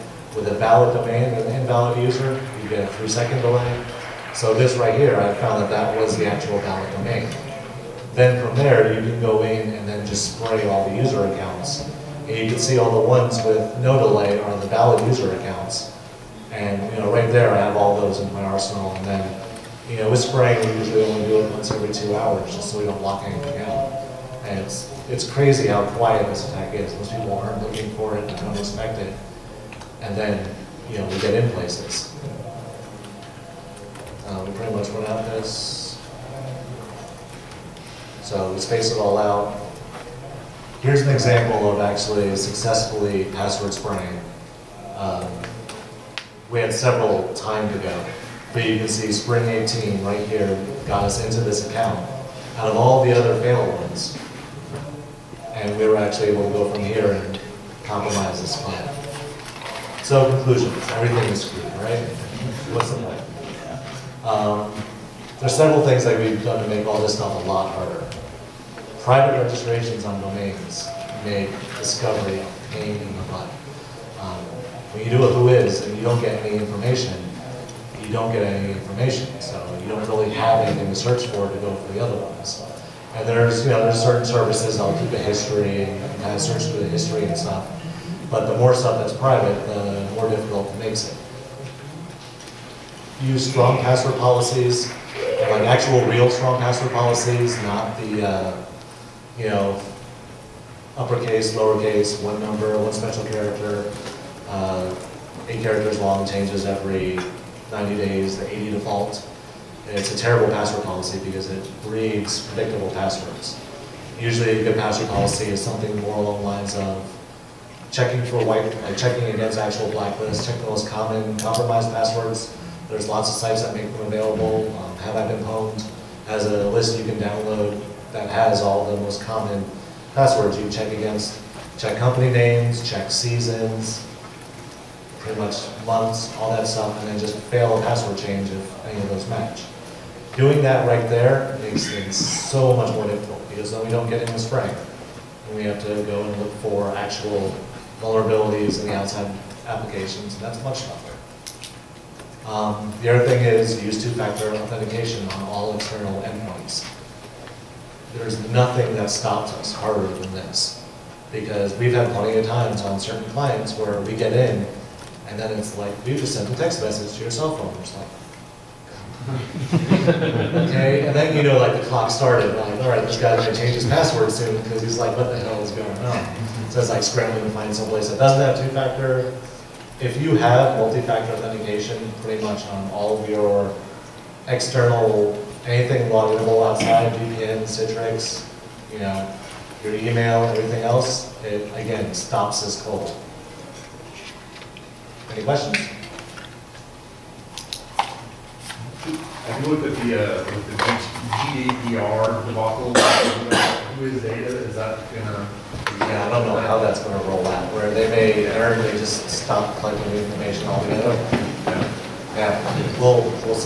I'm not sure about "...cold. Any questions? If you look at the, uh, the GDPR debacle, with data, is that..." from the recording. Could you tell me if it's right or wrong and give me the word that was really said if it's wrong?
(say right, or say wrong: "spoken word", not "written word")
right.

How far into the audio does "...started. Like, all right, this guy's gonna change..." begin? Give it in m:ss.
2:52.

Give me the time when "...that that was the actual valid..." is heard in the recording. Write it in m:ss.
0:05.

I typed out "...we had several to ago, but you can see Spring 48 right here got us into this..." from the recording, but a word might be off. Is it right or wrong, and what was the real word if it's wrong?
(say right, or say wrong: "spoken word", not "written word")
wrong: "18", not "48".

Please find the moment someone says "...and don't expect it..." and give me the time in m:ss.
0:28.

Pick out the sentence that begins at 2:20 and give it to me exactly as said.
Doing that right there makes things so much more difficult because then we don't get in the spring.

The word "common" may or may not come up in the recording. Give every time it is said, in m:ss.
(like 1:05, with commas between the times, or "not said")
2:00, 2:09.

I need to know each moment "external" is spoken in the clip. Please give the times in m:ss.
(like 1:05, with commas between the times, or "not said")
2:35, 3:04.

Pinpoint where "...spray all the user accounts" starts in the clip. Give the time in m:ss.
0:10.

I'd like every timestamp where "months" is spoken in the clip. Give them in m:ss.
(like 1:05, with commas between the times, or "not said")
2:15.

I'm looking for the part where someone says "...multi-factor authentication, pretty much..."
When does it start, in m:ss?
3:00.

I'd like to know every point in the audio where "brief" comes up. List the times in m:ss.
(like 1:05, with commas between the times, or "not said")
not said.